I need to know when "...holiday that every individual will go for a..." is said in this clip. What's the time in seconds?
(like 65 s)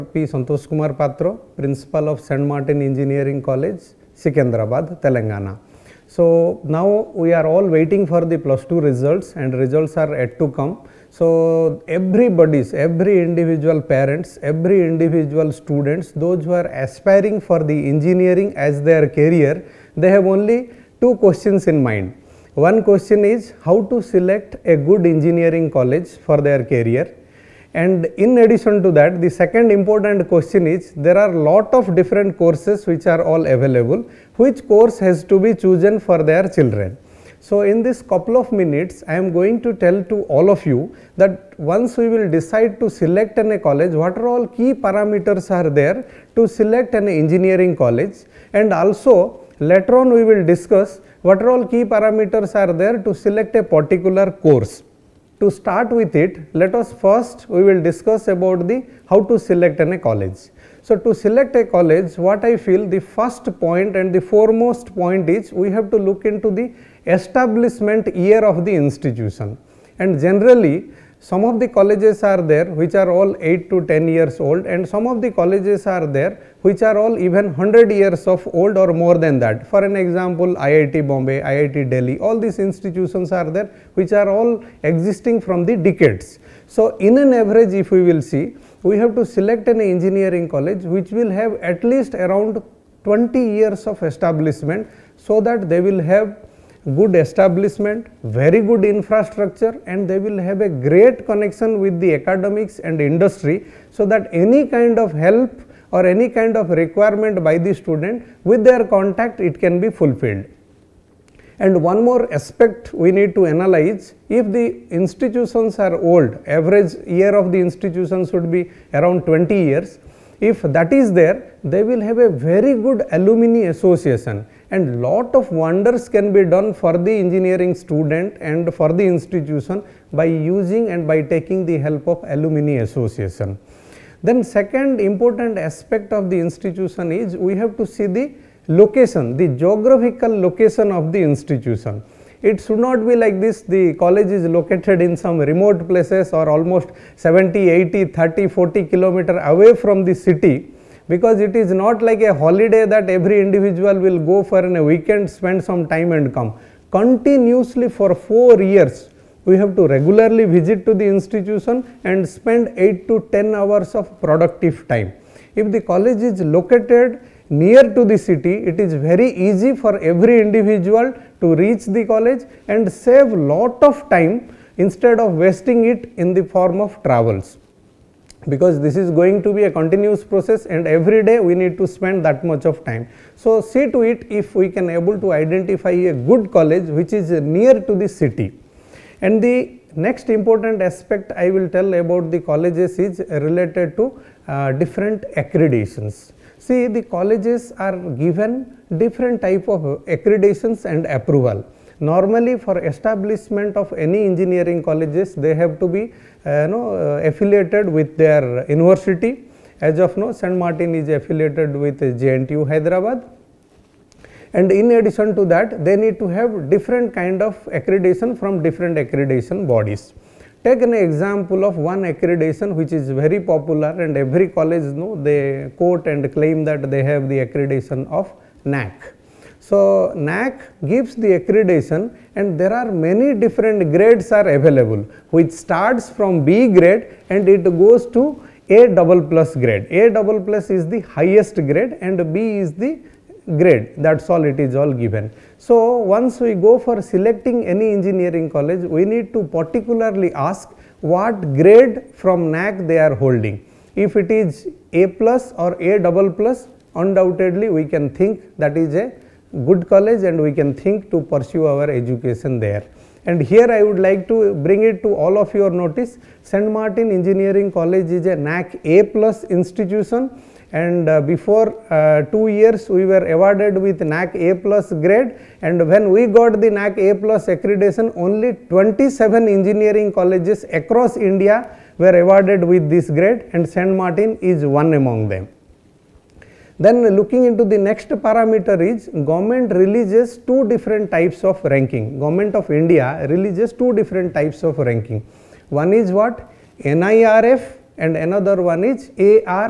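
152 s.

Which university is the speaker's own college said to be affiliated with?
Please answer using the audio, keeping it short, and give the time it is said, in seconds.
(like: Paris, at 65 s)
JNTU Hyderabad, at 212 s.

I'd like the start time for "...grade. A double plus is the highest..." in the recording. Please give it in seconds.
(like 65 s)
239 s.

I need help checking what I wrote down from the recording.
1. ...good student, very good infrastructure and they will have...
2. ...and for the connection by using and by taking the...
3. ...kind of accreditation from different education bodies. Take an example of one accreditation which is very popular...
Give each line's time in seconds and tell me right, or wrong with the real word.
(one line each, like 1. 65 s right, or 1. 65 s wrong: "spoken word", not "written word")
1. 96 s wrong: "establishment", not "student"
2. 128 s wrong: "institution", not "connection"
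3. 217 s wrong: "accreditation", not "education".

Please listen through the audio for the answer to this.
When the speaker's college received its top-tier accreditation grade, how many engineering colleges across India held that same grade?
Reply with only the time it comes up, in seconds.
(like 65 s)
278 s.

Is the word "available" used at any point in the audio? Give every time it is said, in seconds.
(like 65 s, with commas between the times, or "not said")
33 s, 234 s.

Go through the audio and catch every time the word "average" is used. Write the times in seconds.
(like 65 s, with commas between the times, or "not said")
87 s, 116 s.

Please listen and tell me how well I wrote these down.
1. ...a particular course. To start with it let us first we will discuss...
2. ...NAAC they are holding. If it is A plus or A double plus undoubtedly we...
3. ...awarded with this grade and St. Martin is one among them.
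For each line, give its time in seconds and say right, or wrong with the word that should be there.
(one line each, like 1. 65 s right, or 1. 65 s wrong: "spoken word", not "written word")
1. 53 s right
2. 252 s right
3. 282 s right.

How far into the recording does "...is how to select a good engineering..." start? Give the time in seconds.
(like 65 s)
23 s.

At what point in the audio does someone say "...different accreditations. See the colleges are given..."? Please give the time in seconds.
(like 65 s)
194 s.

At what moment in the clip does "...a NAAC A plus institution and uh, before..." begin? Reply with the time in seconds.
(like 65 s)
268 s.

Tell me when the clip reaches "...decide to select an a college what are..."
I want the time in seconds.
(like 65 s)
42 s.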